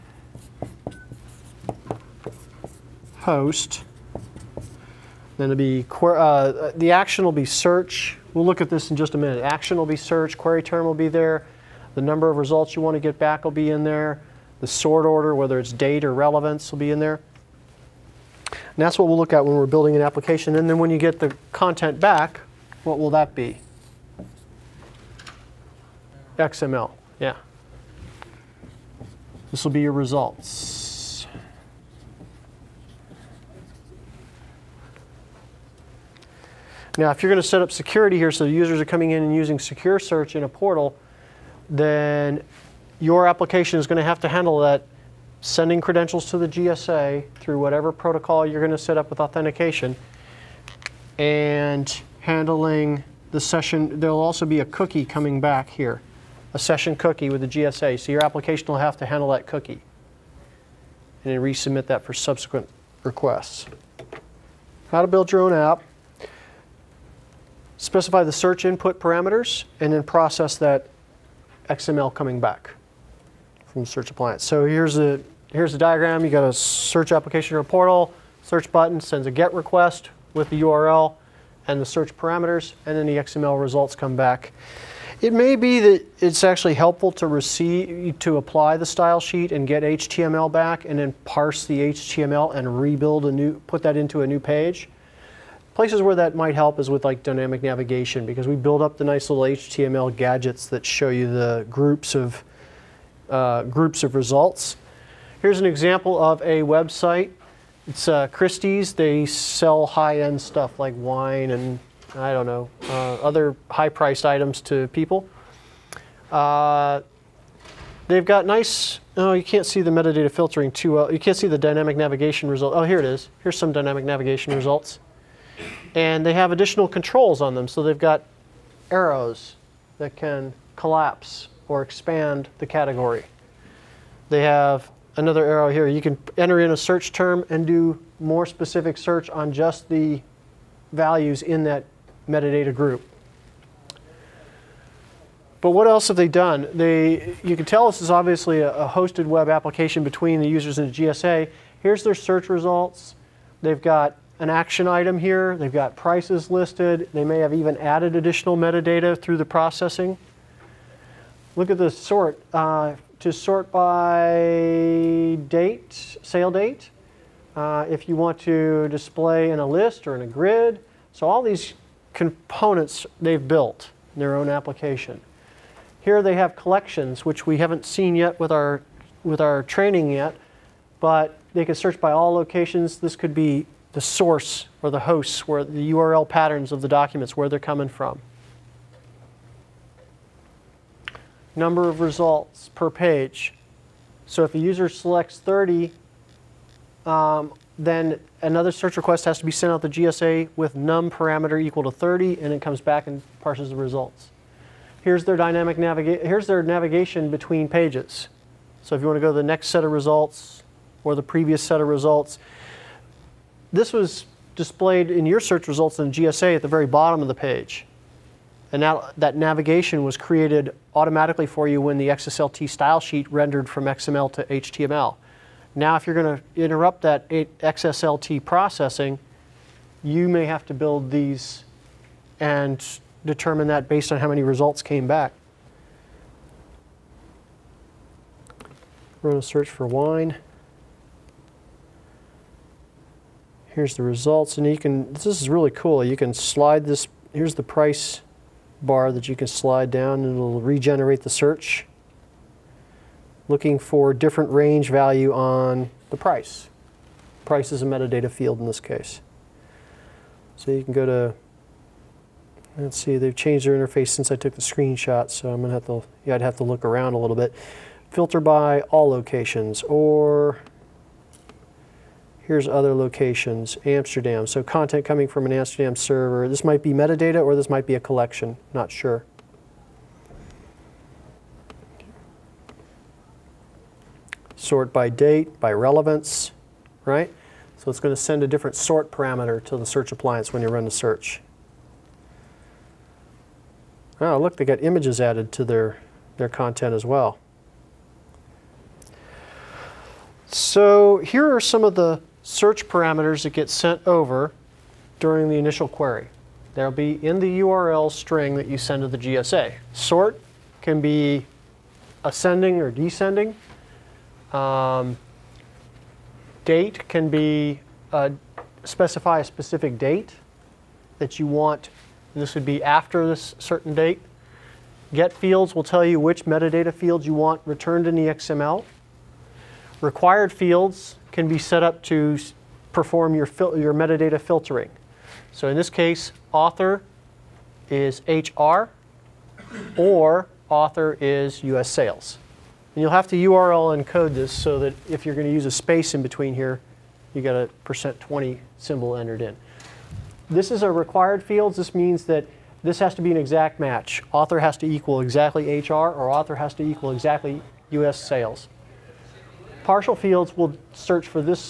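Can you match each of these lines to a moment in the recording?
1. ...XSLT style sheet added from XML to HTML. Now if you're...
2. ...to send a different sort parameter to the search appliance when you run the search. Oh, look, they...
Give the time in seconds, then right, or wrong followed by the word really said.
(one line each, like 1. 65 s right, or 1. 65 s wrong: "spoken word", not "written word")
1. 222 s wrong: "rendered", not "added"
2. 288 s right.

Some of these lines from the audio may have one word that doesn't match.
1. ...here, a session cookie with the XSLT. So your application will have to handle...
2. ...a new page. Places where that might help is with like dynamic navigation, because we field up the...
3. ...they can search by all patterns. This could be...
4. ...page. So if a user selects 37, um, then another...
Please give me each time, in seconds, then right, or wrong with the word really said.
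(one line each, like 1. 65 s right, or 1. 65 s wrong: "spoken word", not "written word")
1. 55 s wrong: "GSA", not "XSLT"
2. 94 s wrong: "build", not "field"
3. 181 s wrong: "locations", not "patterns"
4. 192 s wrong: "30", not "37".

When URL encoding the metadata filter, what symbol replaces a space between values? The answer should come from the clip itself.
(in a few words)
%20.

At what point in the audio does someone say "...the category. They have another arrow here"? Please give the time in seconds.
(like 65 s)
132 s.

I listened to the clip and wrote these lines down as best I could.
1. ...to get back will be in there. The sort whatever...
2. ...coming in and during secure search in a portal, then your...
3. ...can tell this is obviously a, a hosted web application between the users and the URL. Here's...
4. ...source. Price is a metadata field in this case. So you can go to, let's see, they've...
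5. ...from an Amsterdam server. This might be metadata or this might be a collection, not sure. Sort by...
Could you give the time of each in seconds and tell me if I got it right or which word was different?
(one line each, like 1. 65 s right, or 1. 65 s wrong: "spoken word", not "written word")
1. 12 s wrong: "order", not "whatever"
2. 38 s wrong: "using", not "during"
3. 147 s wrong: "GSA", not "URL"
4. 256 s wrong: "price", not "source"
5. 275 s right.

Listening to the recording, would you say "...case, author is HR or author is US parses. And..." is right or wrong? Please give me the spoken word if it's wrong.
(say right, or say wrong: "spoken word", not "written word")
wrong: "sales", not "parses".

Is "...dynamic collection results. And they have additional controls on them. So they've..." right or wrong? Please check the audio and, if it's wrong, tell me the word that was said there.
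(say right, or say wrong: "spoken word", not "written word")
wrong: "navigation", not "collection".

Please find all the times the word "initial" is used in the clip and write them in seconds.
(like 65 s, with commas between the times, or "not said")
305 s.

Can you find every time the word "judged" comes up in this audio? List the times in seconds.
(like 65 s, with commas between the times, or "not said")
not said.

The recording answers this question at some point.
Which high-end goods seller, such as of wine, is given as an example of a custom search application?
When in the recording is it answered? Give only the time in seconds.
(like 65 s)
108 s.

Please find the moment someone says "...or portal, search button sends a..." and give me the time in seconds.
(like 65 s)
77 s.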